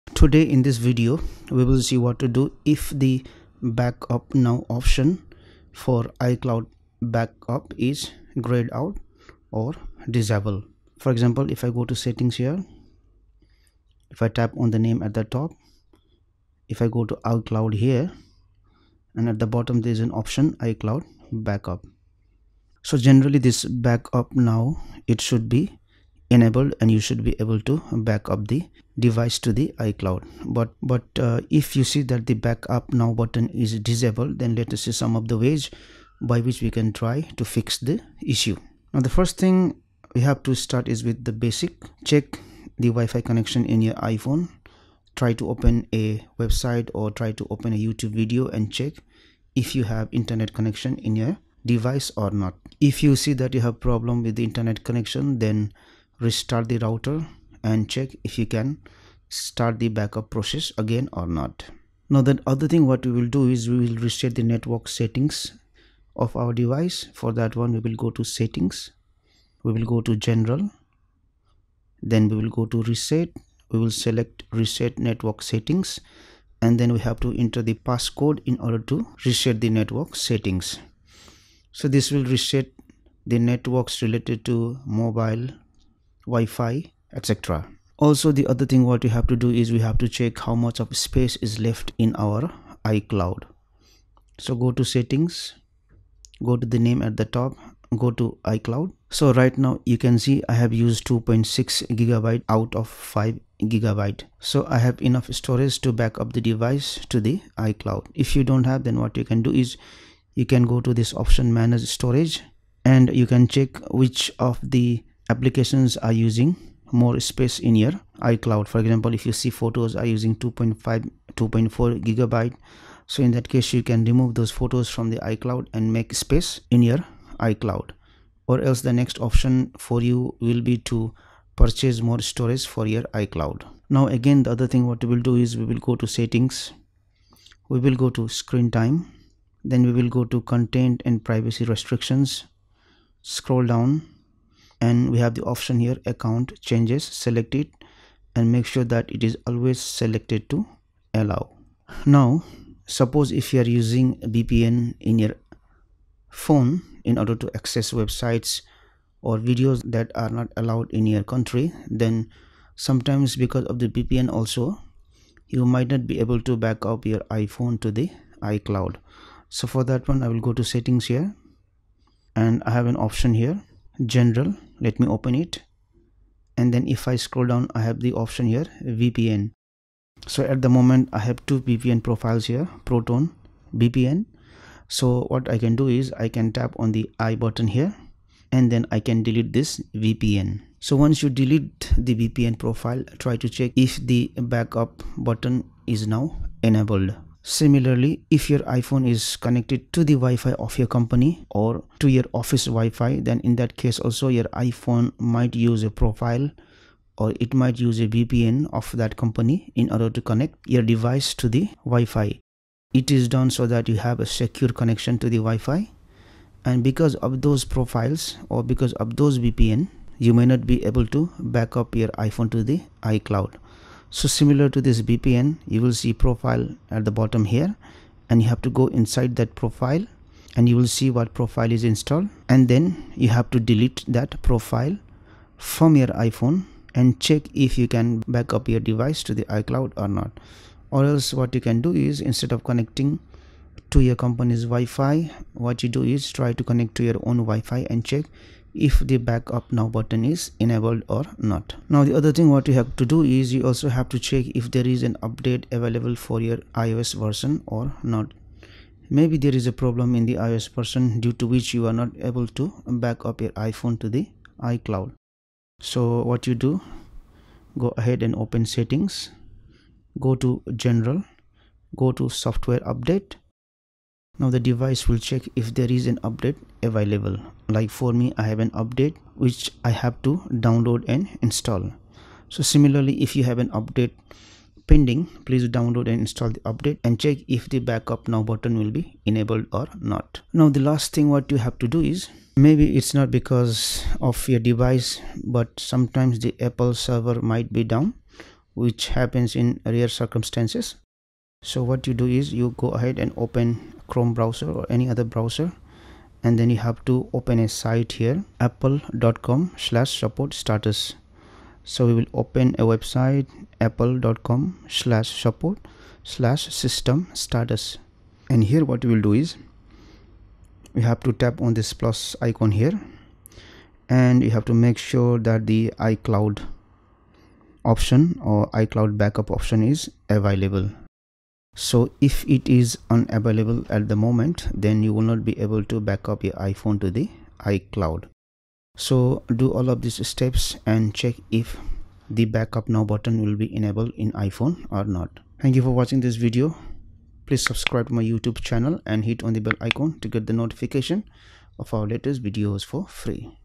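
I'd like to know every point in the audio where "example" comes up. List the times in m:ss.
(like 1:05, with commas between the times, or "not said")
0:11, 1:58.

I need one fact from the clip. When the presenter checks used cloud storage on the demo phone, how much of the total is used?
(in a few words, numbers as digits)
2.6 gigabytes.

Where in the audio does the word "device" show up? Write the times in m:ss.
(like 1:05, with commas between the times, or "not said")
0:28, 0:51, 1:06, 1:46, 3:30, 3:58, 4:34, 4:54.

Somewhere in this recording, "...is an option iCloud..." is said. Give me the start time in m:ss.
0:19.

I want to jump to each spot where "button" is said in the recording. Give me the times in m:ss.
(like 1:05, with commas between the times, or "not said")
0:33, 3:07, 3:15, 4:09, 4:48, 5:43.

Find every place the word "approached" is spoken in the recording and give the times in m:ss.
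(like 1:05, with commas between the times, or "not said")
not said.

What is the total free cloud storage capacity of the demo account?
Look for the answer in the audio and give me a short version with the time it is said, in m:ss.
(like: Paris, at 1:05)
5 gigabytes, at 1:42.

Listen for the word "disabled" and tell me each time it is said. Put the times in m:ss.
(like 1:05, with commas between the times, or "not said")
0:10, 0:33.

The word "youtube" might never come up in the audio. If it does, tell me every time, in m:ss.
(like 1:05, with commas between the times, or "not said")
0:47, 5:48.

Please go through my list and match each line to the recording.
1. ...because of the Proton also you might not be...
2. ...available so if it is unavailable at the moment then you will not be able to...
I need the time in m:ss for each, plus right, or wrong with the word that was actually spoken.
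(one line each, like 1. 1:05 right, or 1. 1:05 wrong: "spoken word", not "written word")
1. 2:43 wrong: "VPN", not "Proton"
2. 5:30 right.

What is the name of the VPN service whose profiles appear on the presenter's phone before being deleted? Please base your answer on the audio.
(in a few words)
Proton VPN.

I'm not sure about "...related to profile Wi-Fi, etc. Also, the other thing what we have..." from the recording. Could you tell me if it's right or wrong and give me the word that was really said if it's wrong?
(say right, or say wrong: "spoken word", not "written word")
wrong: "mobile", not "profile".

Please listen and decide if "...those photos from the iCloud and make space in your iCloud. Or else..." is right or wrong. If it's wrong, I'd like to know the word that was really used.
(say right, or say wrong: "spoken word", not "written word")
right.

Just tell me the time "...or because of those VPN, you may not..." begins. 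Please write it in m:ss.
3:38.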